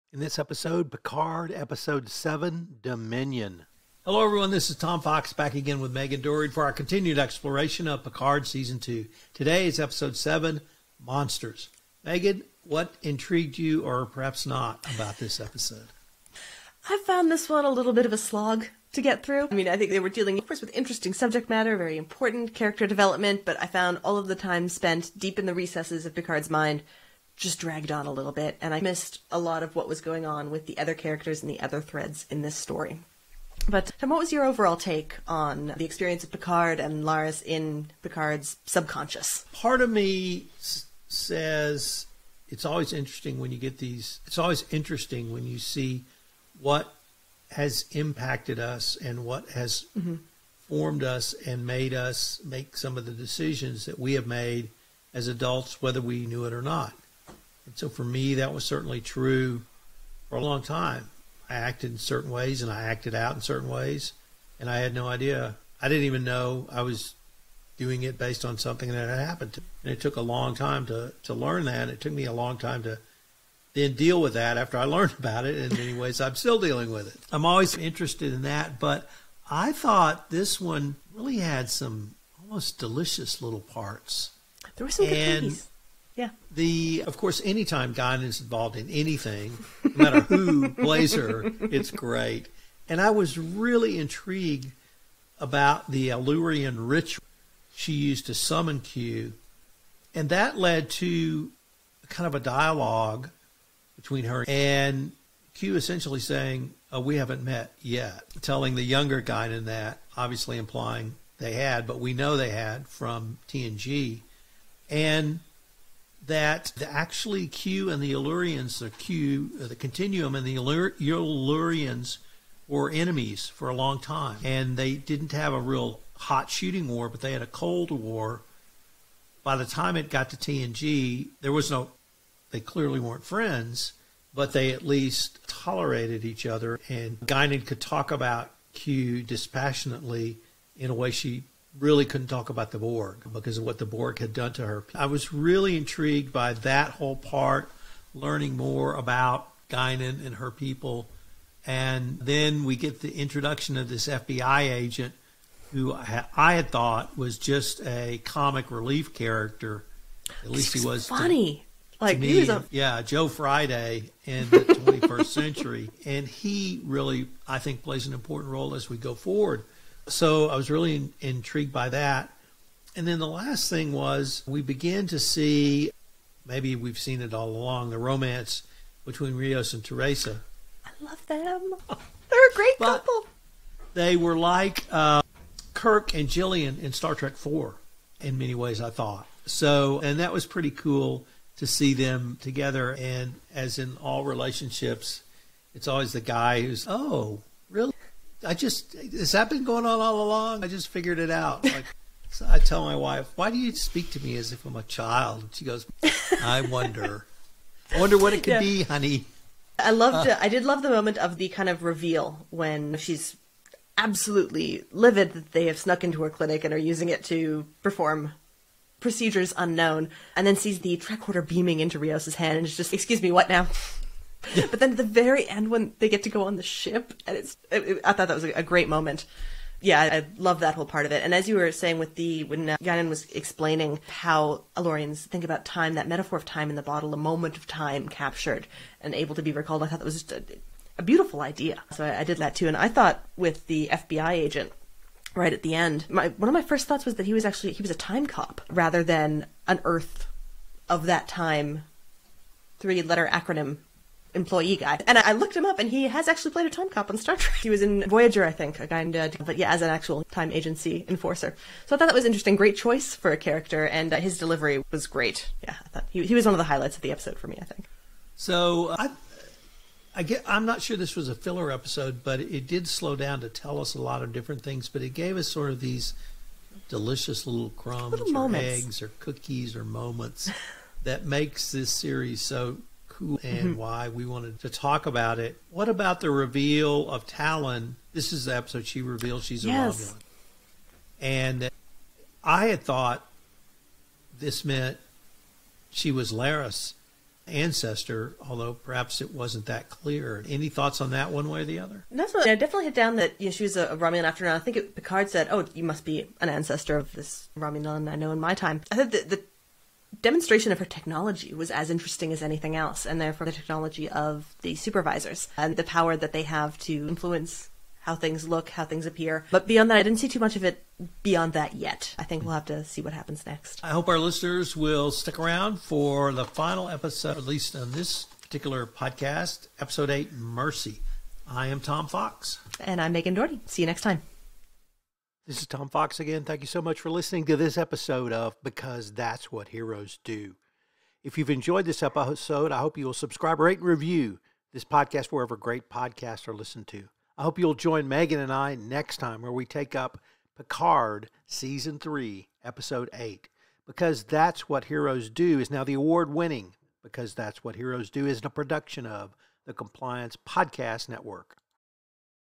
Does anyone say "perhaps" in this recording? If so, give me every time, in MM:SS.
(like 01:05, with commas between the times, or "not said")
00:14, 04:58.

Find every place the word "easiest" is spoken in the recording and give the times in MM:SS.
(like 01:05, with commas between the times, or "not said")
not said.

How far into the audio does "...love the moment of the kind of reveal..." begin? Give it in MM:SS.
03:30.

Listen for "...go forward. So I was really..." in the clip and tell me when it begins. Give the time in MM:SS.
02:48.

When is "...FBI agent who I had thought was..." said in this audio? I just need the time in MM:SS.
02:34.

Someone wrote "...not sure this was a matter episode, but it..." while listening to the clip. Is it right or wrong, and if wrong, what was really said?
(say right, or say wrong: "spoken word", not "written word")
wrong: "filler", not "matter".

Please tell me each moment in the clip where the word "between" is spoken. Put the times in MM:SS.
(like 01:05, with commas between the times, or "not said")
01:43, 02:59.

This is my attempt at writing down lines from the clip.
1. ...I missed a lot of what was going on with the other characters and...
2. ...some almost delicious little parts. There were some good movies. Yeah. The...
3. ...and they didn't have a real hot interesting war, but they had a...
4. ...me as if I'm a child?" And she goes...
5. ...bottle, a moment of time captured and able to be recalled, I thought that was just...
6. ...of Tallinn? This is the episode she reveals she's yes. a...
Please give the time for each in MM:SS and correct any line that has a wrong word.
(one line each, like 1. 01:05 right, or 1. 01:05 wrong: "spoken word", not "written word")
1. 00:28 right
2. 01:21 right
3. 02:04 wrong: "shooting", not "interesting"
4. 03:24 right
5. 03:56 right
6. 04:47 right.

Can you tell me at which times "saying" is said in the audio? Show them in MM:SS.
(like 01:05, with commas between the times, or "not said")
01:46, 03:51.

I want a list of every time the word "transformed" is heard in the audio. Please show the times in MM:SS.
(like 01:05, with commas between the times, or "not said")
not said.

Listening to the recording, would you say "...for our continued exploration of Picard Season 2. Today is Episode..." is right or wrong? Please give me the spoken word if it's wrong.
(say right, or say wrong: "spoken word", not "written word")
right.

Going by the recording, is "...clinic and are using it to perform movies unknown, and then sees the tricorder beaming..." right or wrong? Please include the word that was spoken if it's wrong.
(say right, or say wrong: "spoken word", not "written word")
wrong: "procedures", not "movies".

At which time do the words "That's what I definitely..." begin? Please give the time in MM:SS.
05:02.